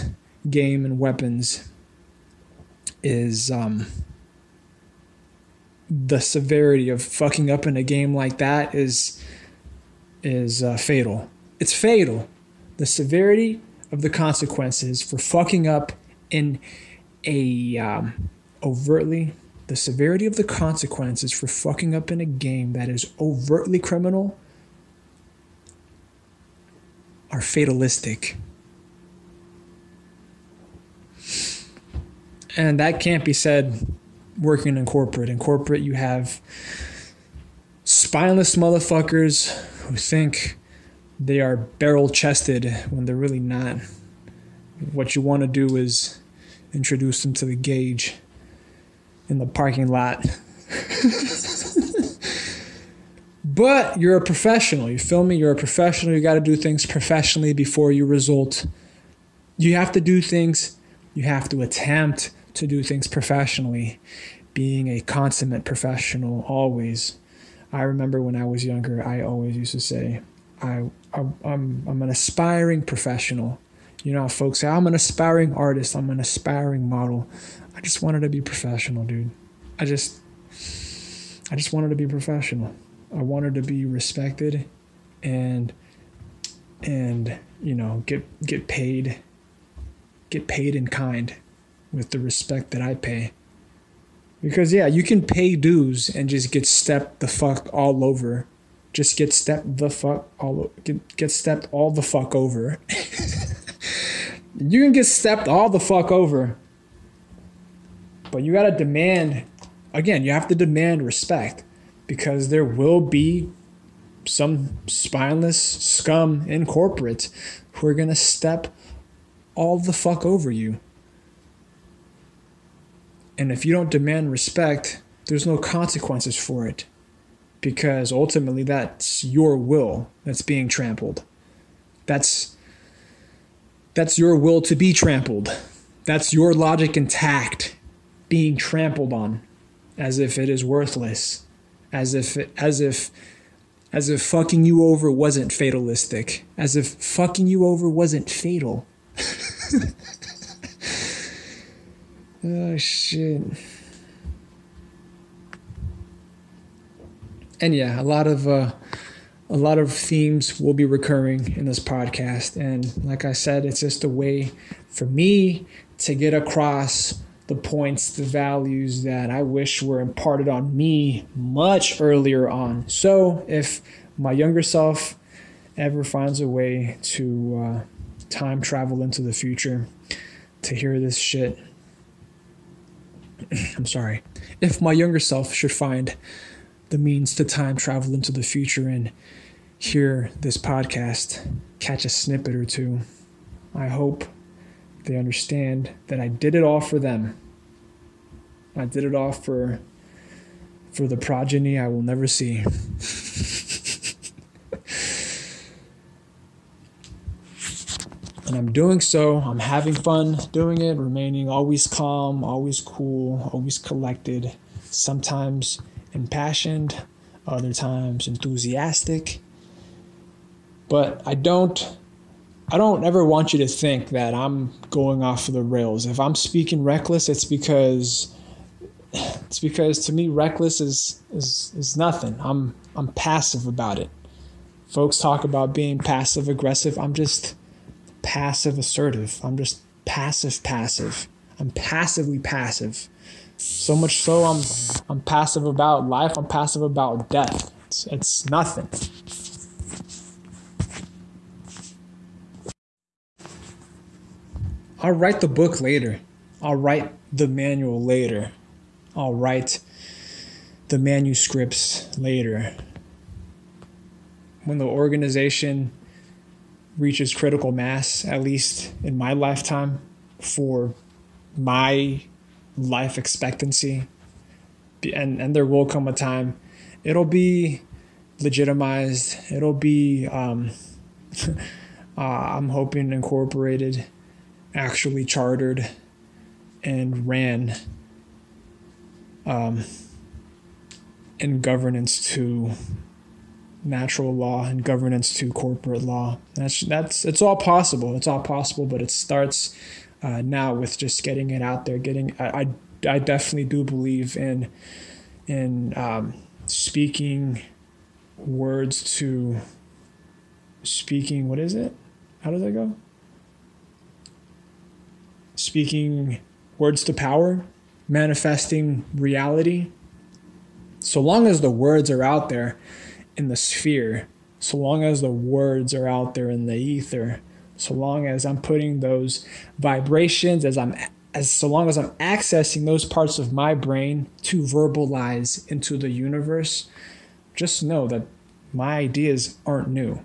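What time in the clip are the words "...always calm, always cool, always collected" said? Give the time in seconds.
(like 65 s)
211 s.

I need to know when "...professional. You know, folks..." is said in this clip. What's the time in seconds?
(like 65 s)
72 s.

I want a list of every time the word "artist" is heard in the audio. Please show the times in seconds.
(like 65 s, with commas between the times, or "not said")
75 s.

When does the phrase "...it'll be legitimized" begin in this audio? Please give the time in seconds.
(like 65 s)
277 s.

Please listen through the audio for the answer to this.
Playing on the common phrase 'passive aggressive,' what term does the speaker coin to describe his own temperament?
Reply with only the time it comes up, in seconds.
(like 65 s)
238 s.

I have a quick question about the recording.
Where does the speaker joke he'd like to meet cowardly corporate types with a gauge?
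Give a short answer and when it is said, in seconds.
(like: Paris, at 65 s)
the parking lot, at 49 s.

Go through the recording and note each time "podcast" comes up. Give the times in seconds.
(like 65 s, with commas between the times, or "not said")
161 s, 190 s.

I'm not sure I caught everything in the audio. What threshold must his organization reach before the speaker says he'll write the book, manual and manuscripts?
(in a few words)
critical mass.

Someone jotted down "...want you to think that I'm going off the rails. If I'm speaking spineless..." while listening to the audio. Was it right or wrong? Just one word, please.
wrong.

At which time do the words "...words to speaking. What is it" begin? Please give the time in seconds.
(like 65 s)
308 s.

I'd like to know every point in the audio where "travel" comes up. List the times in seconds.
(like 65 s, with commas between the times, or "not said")
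178 s, 187 s.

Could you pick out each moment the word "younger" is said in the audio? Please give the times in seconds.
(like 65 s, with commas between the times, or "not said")
68 s, 174 s, 184 s.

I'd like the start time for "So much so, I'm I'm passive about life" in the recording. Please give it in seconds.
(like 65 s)
243 s.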